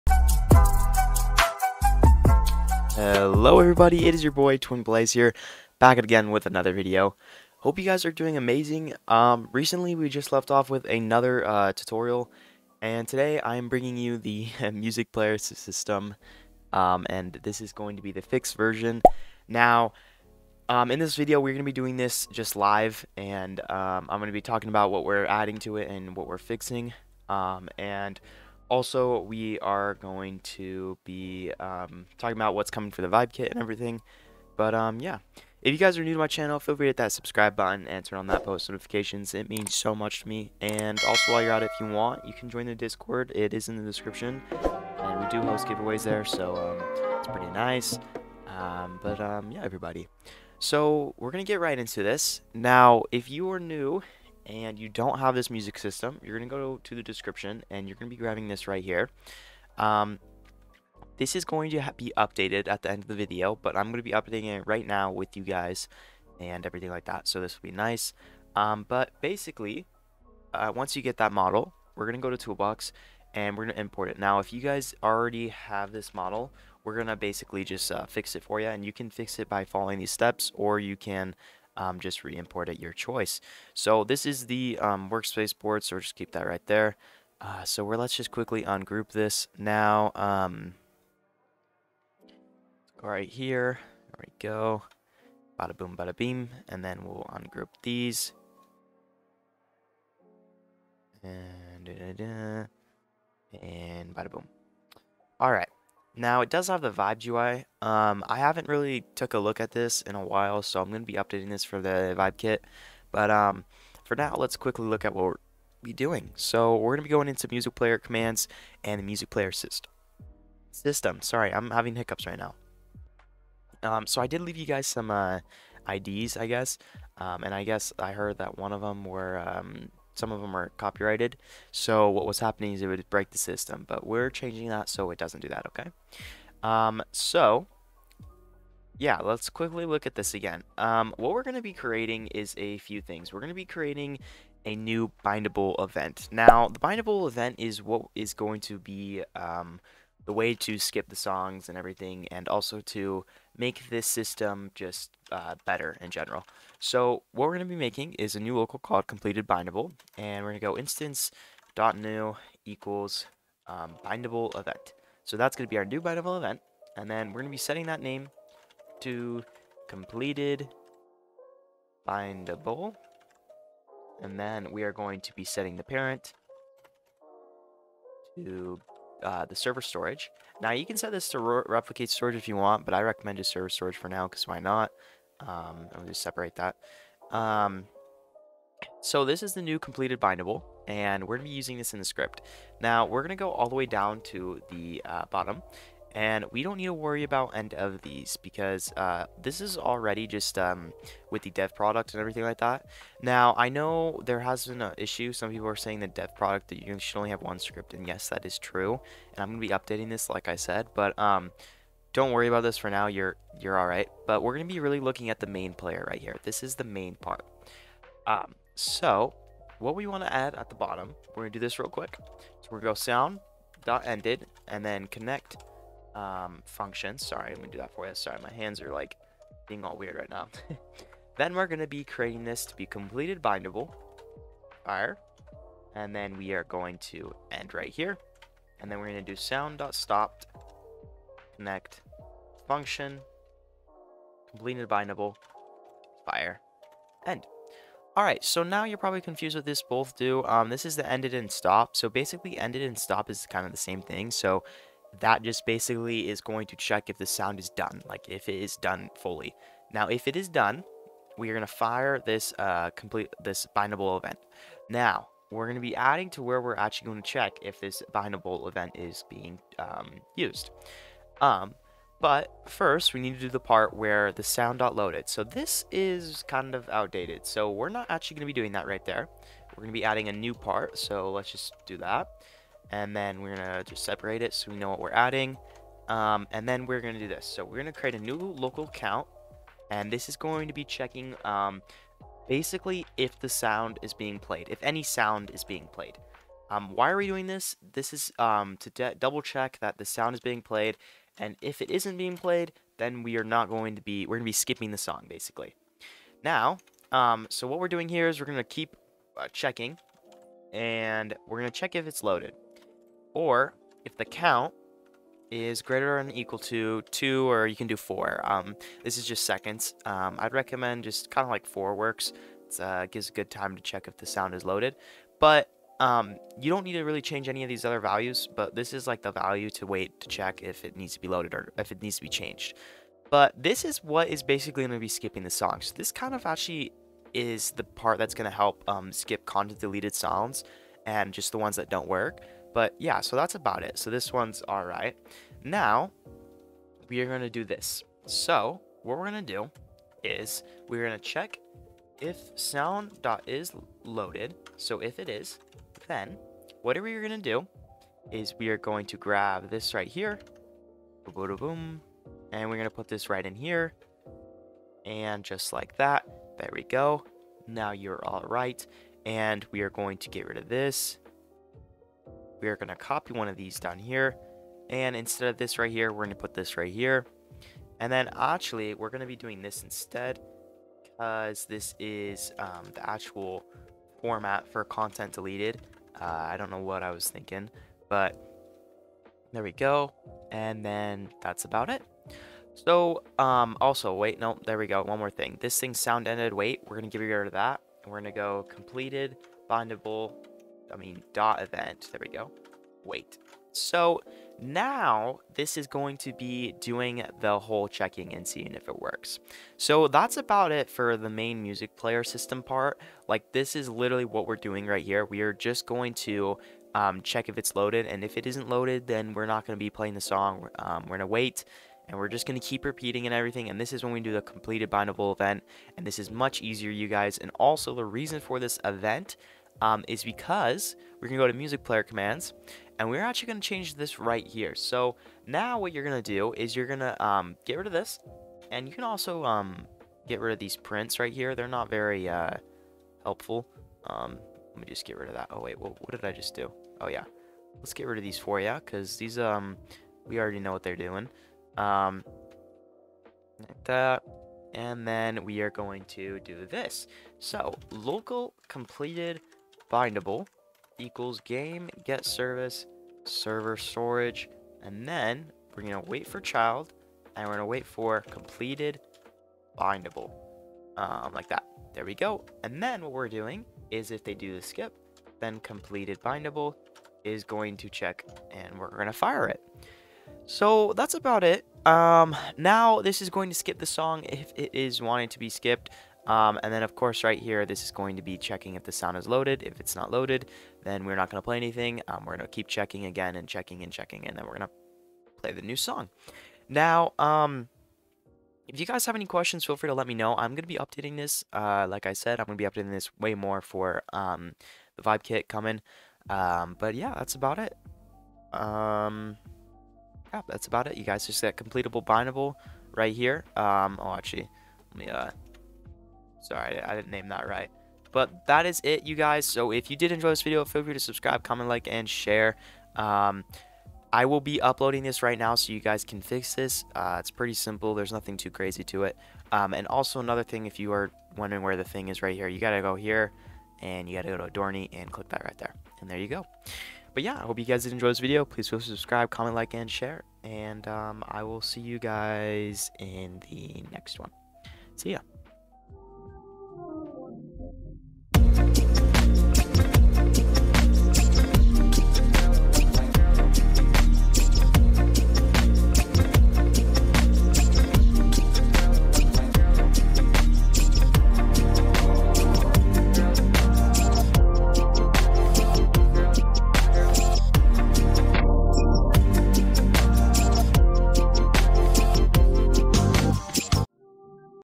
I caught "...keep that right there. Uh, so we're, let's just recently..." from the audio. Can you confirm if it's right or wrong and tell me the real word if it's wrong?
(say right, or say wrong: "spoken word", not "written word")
wrong: "quickly", not "recently".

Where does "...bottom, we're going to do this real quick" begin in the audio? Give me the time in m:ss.
3:40.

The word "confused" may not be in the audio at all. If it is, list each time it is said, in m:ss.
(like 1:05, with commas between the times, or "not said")
4:09.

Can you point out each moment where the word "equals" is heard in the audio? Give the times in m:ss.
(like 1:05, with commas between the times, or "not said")
2:42, 5:16, 7:40.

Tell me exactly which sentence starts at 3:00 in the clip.
Now you can set this to replicate storage if you want, but I recommend just server storage for now because why not?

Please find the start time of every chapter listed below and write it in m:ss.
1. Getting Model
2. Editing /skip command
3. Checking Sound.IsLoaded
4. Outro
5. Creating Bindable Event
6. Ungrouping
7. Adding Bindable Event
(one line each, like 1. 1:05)
1. 1:00
2. 7:20
3. 4:50
4. 8:50
5. 2:15
6. 1:24
7. 3:40.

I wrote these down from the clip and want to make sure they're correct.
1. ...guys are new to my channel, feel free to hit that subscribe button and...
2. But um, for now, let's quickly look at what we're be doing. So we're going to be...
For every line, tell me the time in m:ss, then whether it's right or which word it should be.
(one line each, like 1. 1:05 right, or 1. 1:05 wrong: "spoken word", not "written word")
1. 0:35 right
2. 1:53 right.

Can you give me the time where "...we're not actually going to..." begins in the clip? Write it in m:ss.
4:37.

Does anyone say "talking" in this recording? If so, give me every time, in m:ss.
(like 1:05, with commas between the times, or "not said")
0:24, 0:32.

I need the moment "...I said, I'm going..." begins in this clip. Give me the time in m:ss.
8:22.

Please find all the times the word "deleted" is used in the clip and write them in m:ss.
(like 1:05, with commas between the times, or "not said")
5:39, 6:25.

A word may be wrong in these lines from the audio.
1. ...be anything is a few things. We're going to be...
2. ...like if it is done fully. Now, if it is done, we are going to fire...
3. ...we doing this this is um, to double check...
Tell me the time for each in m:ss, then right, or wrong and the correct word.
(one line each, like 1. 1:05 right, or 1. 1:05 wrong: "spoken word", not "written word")
1. 2:21 wrong: "creating", not "anything"
2. 4:18 right
3. 4:57 right.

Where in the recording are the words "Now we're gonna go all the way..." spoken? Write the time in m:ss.
3:12.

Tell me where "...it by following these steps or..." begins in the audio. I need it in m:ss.
1:19.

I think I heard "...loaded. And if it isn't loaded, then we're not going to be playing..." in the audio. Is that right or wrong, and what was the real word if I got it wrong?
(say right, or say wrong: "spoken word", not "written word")
right.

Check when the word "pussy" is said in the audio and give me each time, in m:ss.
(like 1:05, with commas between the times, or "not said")
not said.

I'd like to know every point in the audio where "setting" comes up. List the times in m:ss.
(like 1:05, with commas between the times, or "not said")
2:47, 2:55.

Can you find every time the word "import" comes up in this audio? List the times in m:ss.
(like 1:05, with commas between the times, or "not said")
1:13, 1:22.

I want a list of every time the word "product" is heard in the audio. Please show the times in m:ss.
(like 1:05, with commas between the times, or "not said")
3:21, 3:26.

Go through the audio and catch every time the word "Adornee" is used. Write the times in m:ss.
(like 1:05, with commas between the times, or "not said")
8:54.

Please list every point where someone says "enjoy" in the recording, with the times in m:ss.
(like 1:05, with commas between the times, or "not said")
8:40, 8:57.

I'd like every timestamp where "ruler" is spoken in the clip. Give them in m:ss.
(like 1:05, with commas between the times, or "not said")
not said.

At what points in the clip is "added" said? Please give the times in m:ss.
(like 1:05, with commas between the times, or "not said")
not said.